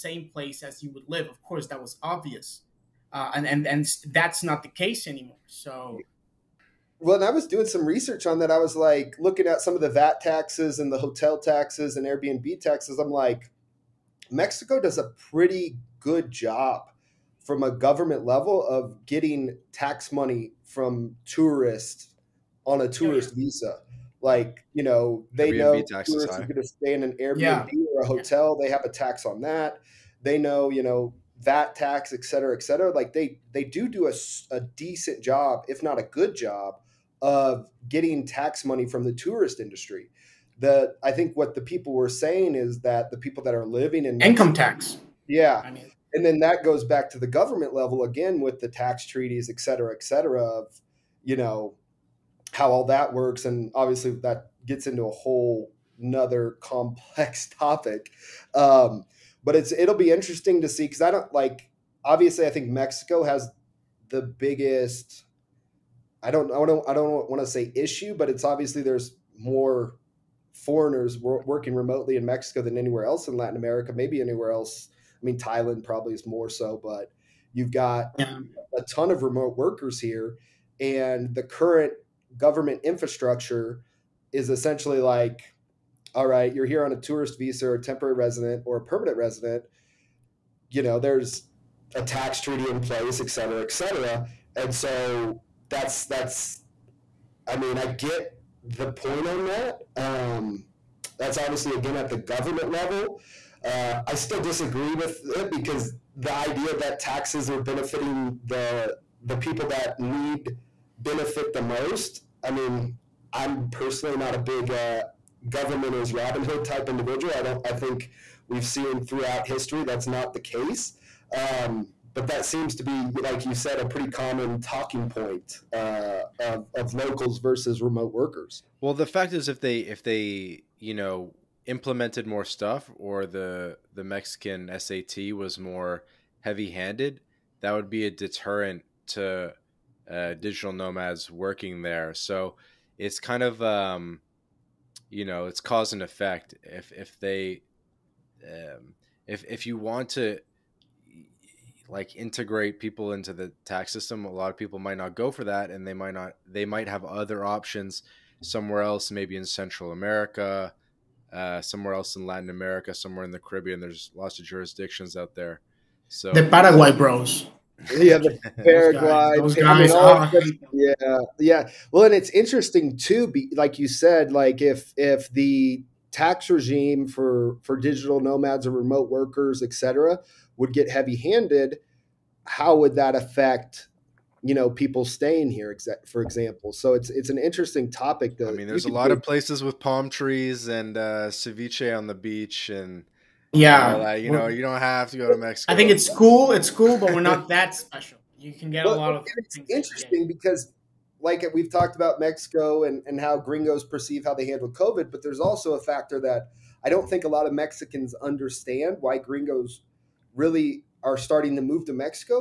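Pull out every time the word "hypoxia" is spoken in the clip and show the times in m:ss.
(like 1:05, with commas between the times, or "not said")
not said.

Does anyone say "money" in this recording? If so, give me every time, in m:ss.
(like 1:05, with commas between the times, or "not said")
0:20, 0:38.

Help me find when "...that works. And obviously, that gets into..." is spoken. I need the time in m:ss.
0:52.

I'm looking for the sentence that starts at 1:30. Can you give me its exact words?
You know, there's a tax treaty in place, et cetera, et cetera.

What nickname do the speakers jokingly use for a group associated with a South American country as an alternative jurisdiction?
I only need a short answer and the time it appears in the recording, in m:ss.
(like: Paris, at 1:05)
the Paraguay Bros, at 2:46.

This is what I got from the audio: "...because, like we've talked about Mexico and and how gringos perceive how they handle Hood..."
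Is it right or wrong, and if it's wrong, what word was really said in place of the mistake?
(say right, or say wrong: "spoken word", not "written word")
wrong: "COVID", not "Hood".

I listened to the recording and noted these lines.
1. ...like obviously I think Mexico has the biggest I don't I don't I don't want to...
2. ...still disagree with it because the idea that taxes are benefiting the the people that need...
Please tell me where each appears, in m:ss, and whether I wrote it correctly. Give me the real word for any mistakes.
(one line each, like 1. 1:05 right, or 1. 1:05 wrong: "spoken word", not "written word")
1. 1:01 right
2. 1:44 right.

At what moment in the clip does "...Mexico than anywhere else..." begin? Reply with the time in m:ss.
1:12.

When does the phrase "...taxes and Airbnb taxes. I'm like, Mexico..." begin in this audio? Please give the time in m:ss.
0:11.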